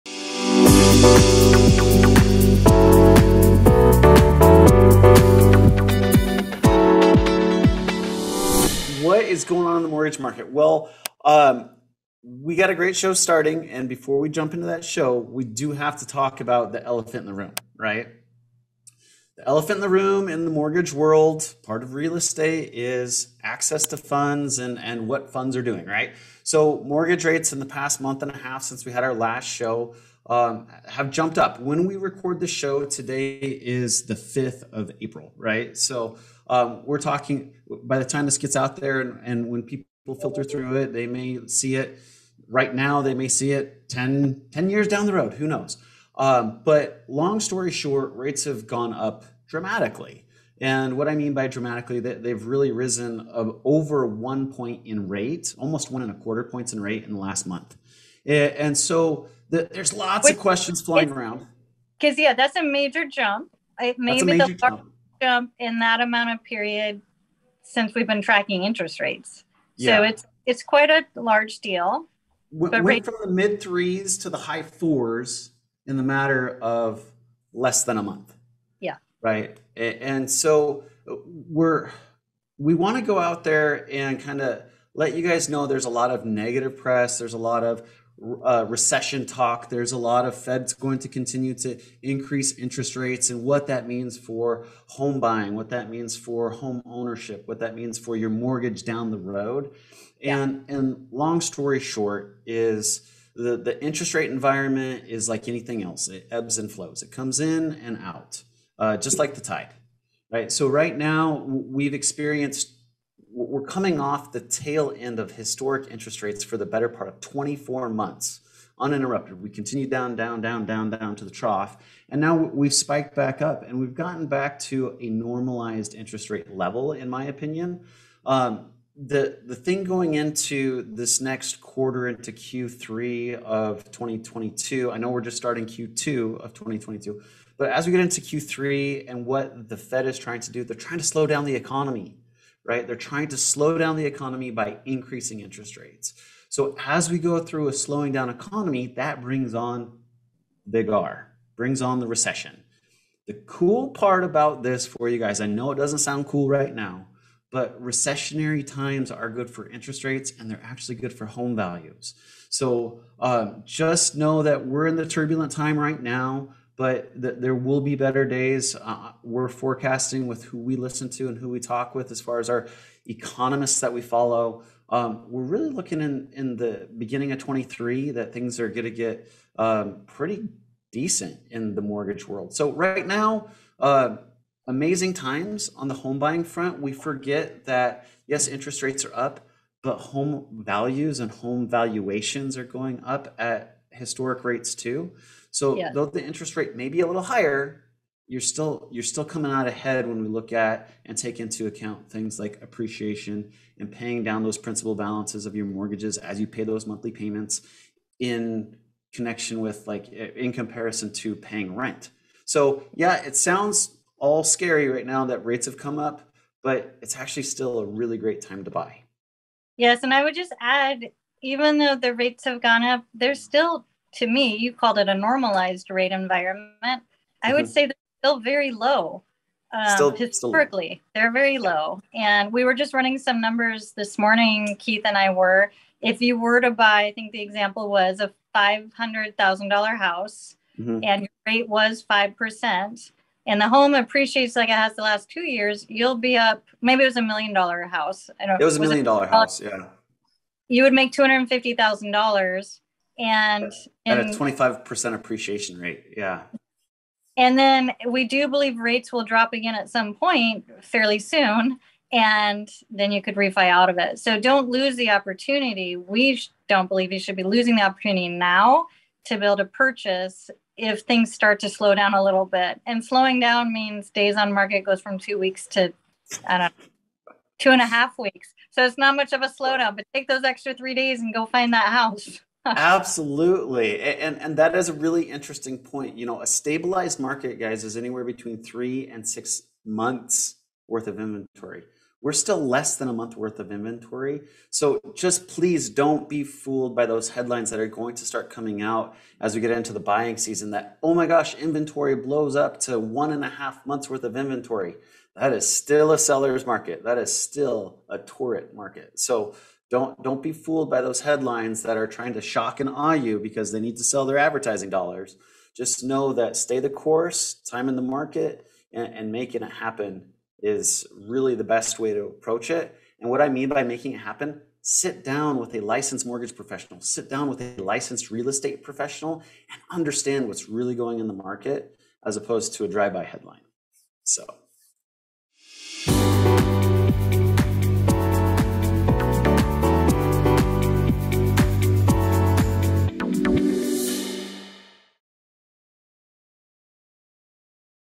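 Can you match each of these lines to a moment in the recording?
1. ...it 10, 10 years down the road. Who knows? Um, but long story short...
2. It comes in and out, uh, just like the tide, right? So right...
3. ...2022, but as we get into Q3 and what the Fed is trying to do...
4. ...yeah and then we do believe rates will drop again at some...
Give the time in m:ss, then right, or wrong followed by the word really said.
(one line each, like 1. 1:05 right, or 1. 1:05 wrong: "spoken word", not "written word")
1. 0:43 right
2. 1:47 right
3. 2:16 right
4. 4:16 right.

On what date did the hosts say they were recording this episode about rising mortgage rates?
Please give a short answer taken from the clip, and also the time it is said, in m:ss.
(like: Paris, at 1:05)
5th of April, at 0:34.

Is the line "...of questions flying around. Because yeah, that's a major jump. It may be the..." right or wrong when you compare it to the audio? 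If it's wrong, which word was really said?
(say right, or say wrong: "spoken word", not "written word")
right.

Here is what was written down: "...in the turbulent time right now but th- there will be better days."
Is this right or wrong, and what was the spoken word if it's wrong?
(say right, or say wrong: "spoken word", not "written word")
right.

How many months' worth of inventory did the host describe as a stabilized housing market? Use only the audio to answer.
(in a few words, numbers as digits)
3 to 6 months.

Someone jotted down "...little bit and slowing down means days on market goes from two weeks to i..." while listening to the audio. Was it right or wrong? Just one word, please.
right.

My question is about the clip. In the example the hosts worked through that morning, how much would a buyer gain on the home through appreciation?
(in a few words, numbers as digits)
$250,000.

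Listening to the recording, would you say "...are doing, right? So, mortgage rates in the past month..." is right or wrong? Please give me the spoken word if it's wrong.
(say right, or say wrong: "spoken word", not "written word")
right.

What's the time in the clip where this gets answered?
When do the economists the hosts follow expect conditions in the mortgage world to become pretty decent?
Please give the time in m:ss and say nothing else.
2:56.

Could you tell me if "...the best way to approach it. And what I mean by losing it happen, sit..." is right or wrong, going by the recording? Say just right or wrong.
wrong.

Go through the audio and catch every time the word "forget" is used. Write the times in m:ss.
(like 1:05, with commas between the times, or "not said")
3:06.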